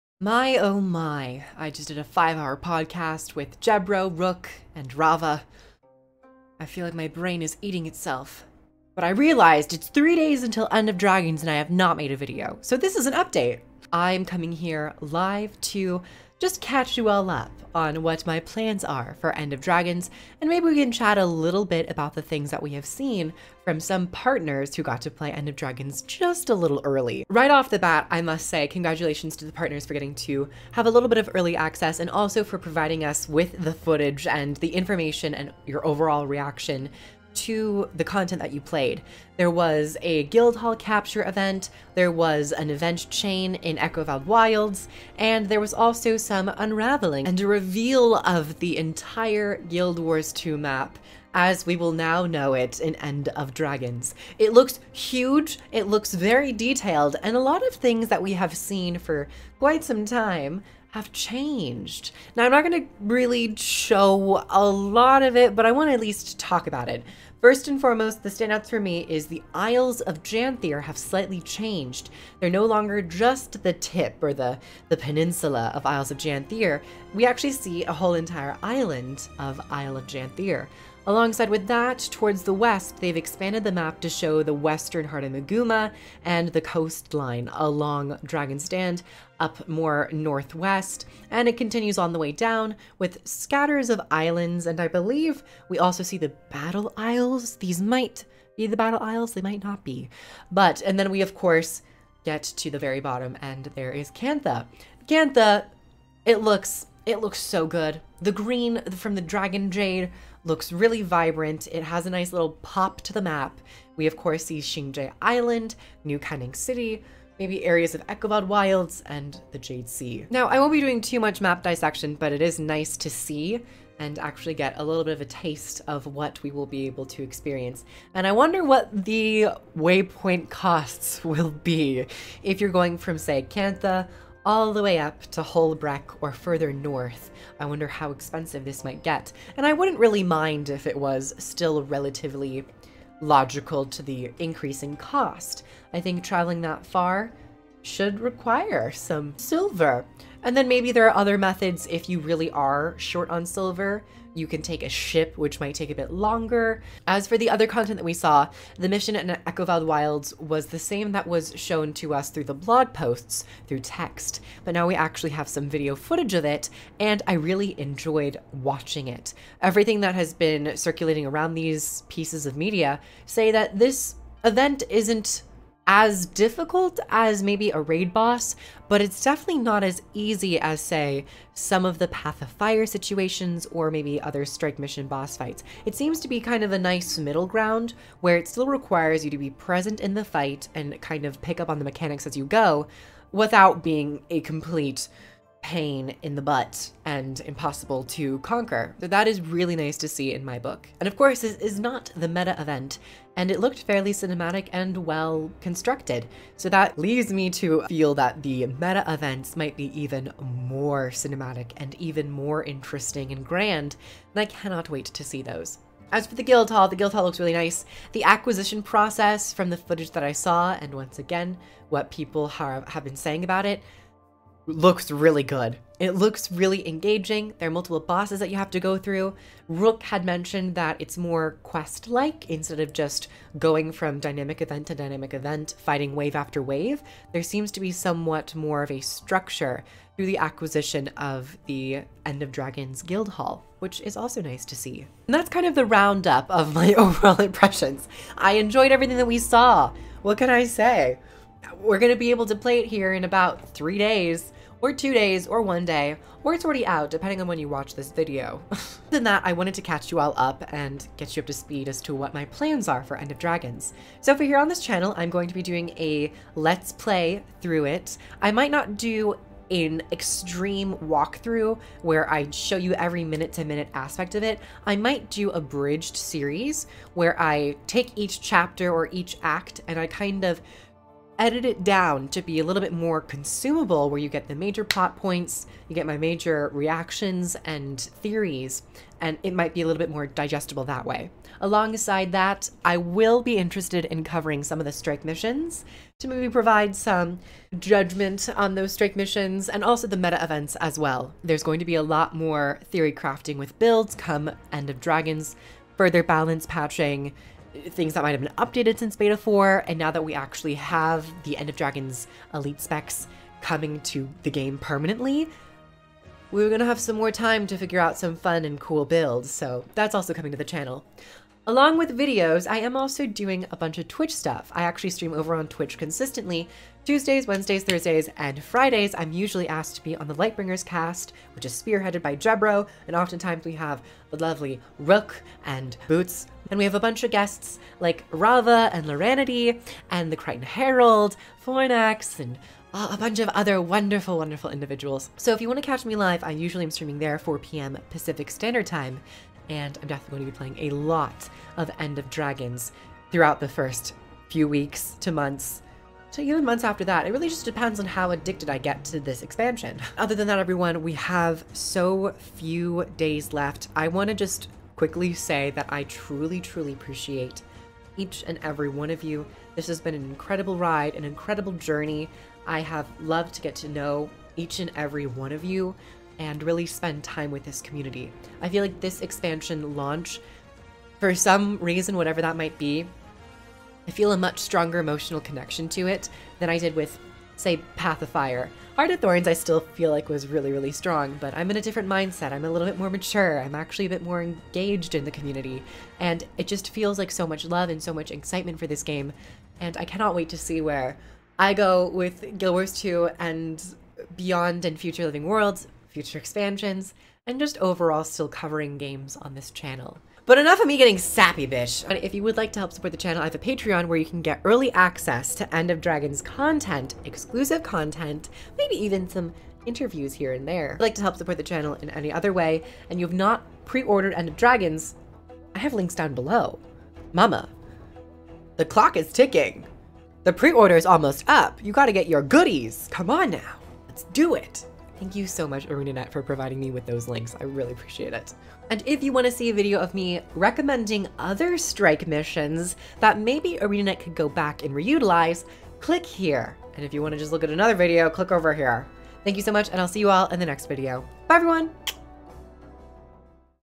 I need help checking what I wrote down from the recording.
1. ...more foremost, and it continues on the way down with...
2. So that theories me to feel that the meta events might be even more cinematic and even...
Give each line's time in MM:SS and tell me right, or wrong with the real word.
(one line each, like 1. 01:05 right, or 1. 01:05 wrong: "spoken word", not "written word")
1. 01:29 wrong: "northwest", not "foremost"
2. 03:26 wrong: "leaves", not "theories".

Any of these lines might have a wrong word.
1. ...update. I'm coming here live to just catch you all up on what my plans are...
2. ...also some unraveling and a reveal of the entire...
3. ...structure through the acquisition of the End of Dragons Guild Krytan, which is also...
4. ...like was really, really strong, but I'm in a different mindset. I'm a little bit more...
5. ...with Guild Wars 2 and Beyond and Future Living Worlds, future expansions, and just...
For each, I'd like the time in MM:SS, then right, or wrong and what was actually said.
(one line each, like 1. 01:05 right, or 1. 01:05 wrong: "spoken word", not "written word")
1. 00:13 right
2. 00:45 right
3. 03:59 wrong: "Hall", not "Krytan"
4. 06:30 right
5. 06:42 right.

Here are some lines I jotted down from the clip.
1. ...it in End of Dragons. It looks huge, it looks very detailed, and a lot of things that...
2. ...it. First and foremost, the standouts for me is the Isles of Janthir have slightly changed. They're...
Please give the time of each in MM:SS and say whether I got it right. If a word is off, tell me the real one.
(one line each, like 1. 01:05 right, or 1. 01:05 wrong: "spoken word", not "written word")
1. 00:52 right
2. 01:06 right.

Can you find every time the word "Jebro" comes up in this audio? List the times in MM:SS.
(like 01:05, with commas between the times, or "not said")
00:03, 05:32.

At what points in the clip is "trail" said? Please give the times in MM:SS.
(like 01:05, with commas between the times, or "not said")
not said.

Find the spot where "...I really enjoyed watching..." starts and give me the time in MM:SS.
02:47.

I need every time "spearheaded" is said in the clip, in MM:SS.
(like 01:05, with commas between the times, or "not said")
05:31.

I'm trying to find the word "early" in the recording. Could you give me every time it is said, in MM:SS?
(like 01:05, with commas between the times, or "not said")
00:26, 00:31, 06:54.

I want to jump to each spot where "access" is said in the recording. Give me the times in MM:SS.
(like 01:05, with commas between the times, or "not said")
00:31, 06:54.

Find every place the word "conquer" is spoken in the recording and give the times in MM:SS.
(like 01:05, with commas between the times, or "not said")
03:18.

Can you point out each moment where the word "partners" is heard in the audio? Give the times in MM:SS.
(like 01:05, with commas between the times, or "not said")
00:24, 00:29.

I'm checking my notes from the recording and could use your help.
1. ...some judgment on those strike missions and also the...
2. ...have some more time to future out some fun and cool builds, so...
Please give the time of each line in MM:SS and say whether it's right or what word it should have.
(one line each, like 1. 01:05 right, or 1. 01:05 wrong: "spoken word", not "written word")
1. 04:56 right
2. 05:16 wrong: "figure", not "future".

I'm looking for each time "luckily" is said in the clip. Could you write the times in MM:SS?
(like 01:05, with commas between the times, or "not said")
not said.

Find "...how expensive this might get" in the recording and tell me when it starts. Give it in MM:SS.
02:17.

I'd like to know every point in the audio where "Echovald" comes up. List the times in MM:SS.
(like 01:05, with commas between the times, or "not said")
00:43, 01:58, 02:39.